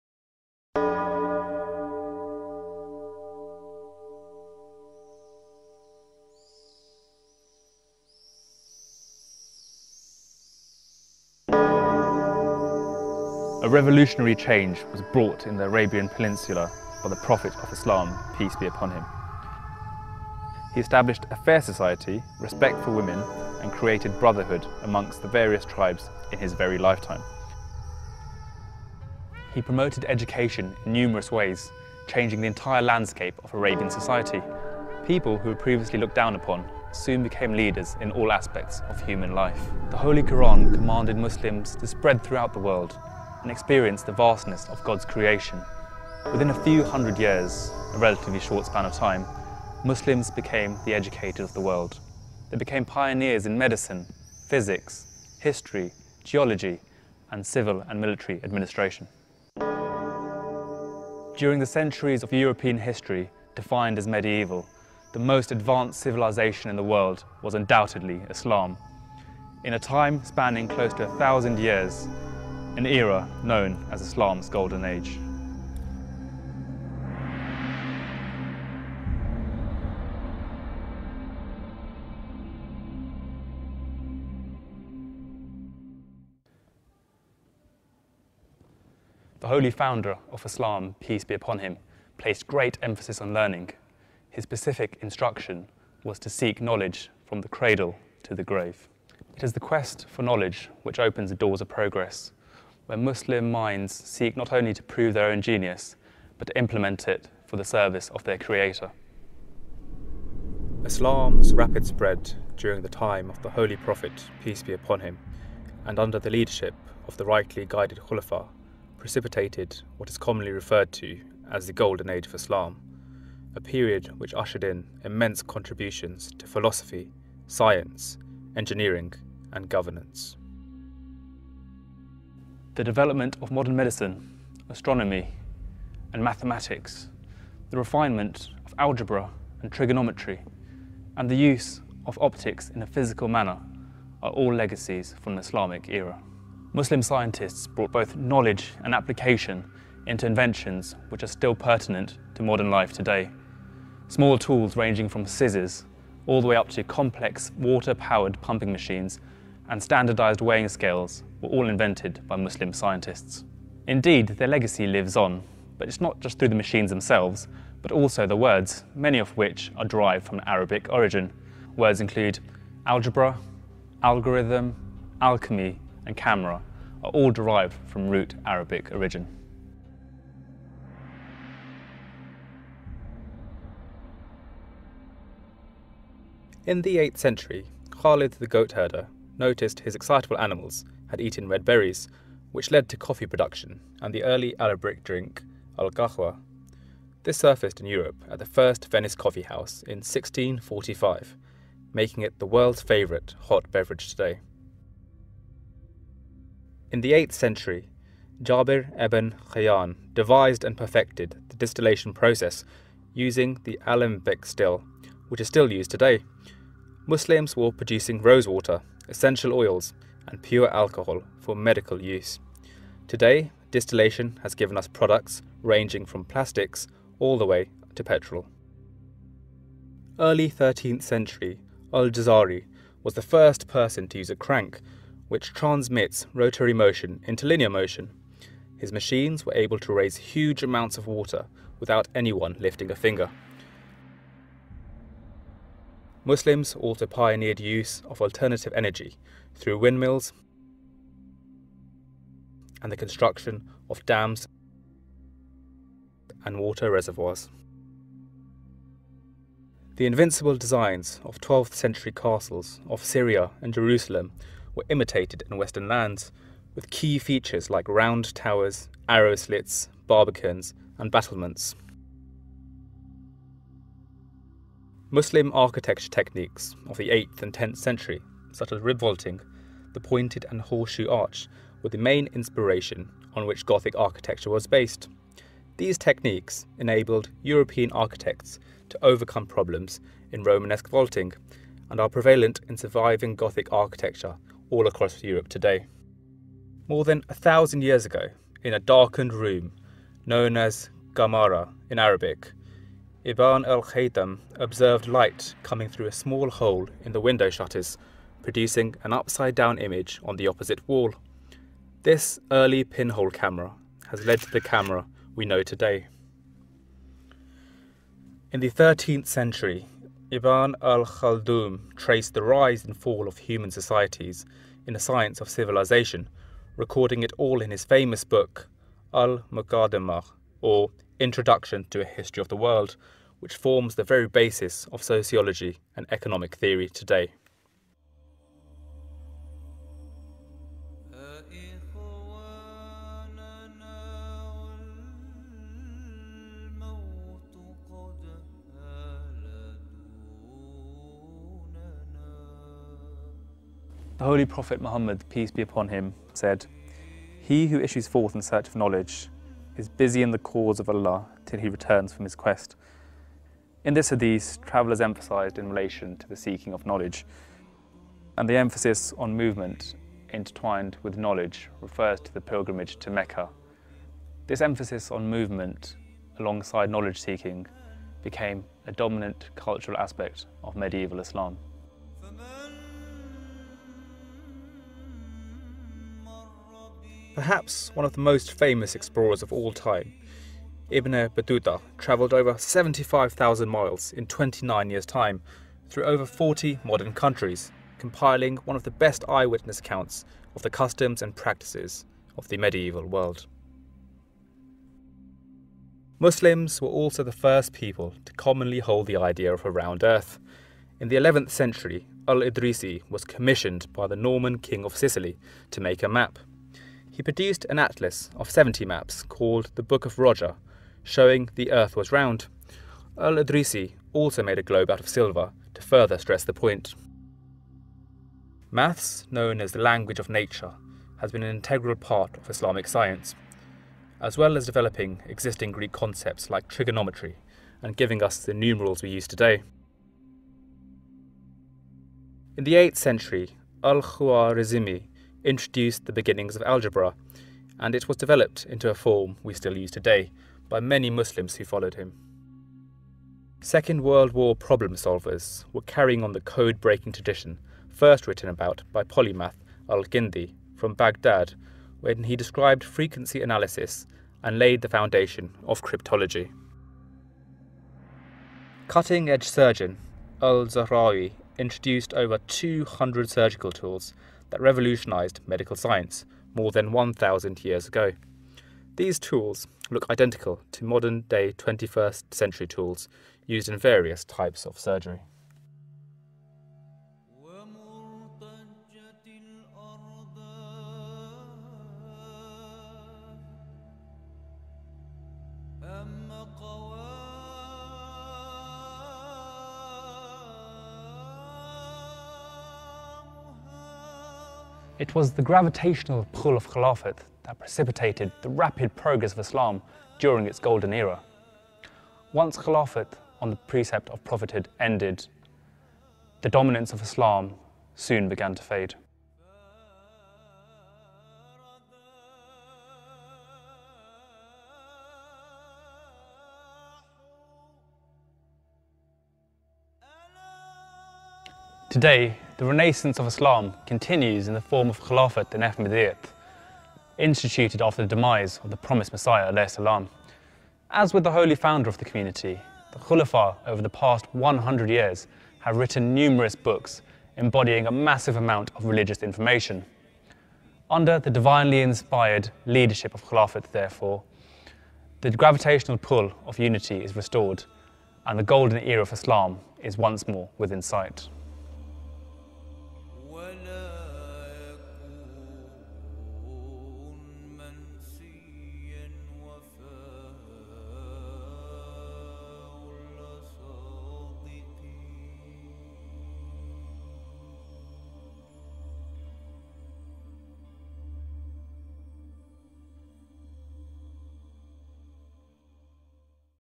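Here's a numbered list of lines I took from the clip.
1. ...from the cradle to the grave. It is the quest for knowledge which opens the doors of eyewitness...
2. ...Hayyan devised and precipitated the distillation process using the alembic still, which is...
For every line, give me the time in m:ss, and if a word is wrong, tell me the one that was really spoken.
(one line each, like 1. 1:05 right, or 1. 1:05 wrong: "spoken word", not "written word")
1. 1:37 wrong: "progress", not "eyewitness"
2. 3:29 wrong: "perfected", not "precipitated".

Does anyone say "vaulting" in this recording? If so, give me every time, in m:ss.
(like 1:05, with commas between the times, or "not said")
4:38, 4:50.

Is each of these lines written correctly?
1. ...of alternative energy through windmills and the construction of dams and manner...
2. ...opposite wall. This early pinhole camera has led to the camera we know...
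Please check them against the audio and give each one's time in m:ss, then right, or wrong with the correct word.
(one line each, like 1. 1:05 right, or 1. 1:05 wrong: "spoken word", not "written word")
1. 4:08 wrong: "water", not "manner"
2. 5:10 right.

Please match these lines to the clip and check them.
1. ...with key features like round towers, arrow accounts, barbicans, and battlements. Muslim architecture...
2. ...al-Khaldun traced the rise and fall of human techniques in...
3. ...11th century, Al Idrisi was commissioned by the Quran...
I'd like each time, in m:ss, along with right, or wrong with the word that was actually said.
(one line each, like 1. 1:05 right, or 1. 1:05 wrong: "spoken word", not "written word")
1. 4:26 wrong: "slits", not "accounts"
2. 5:20 wrong: "societies", not "techniques"
3. 6:51 wrong: "Norman", not "Quran".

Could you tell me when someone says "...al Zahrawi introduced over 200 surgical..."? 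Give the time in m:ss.
7:50.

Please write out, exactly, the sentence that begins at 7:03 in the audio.
Al Idrisi also made a globe out of silver to further stress the point.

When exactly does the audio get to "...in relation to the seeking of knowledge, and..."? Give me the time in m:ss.
6:05.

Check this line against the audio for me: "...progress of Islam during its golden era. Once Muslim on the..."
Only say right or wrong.
wrong.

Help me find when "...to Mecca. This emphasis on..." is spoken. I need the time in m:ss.
6:12.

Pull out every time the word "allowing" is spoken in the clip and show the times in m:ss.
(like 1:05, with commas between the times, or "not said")
not said.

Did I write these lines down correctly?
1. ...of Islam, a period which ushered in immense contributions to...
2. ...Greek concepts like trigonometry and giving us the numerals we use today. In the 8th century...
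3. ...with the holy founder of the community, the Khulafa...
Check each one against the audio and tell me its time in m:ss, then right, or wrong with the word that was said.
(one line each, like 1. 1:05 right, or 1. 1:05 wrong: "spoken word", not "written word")
1. 2:02 right
2. 7:15 right
3. 9:01 right.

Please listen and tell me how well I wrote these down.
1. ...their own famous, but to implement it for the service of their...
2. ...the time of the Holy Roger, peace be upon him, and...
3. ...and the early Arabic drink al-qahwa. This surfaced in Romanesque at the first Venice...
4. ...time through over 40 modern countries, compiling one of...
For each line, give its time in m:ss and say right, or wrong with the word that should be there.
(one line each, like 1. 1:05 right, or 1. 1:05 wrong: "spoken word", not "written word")
1. 1:45 wrong: "genius", not "famous"
2. 1:52 wrong: "Prophet", not "Roger"
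3. 3:14 wrong: "Europe", not "Romanesque"
4. 6:35 right.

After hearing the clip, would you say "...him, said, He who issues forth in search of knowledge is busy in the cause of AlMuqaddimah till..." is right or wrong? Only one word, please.
wrong.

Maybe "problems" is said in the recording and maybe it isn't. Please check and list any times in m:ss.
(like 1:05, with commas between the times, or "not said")
4:49, 7:34.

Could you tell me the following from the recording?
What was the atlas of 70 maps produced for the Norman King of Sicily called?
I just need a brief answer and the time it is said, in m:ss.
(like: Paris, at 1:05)
Book of Roger, at 6:59.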